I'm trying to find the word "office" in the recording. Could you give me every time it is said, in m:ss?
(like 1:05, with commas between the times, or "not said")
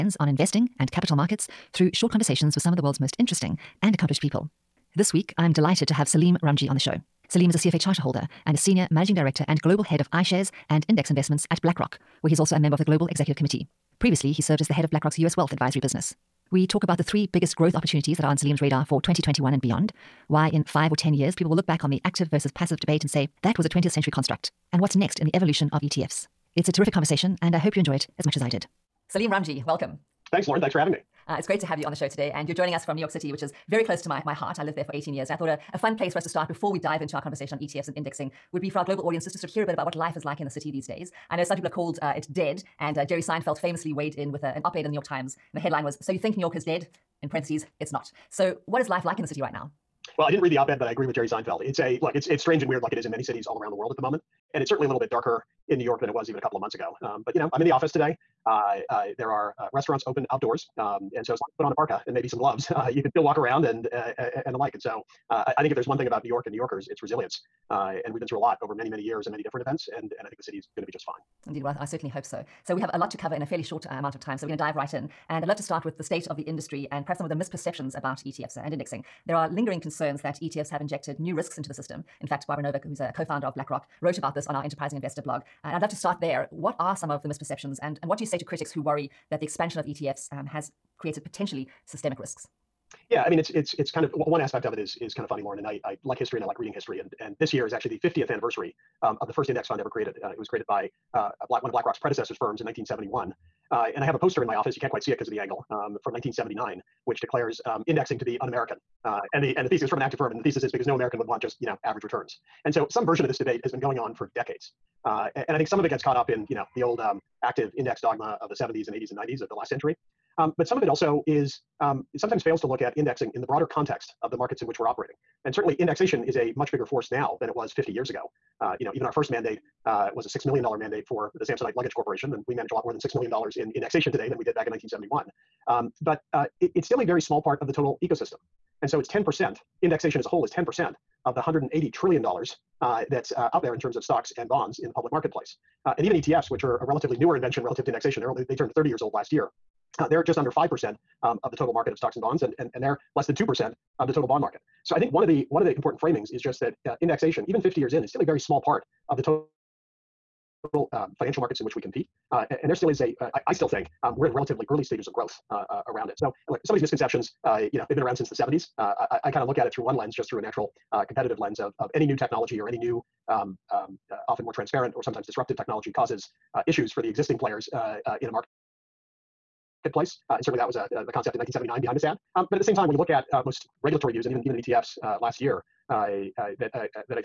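0:57, 1:44.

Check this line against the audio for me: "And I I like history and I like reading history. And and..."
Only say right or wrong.
right.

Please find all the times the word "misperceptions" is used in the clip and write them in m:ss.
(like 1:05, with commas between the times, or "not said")
1:17, 1:27.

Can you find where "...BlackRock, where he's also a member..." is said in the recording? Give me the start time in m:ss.
0:11.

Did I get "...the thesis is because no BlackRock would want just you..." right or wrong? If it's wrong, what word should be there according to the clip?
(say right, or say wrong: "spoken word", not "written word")
wrong: "American", not "BlackRock".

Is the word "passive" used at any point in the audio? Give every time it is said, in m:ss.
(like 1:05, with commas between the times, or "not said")
0:22.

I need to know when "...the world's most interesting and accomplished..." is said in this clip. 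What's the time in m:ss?
0:02.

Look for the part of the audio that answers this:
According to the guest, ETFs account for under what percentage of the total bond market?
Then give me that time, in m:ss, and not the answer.
2:33.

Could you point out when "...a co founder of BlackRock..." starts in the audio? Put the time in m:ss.
1:22.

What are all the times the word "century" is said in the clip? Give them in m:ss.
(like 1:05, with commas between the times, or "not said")
0:23, 1:59.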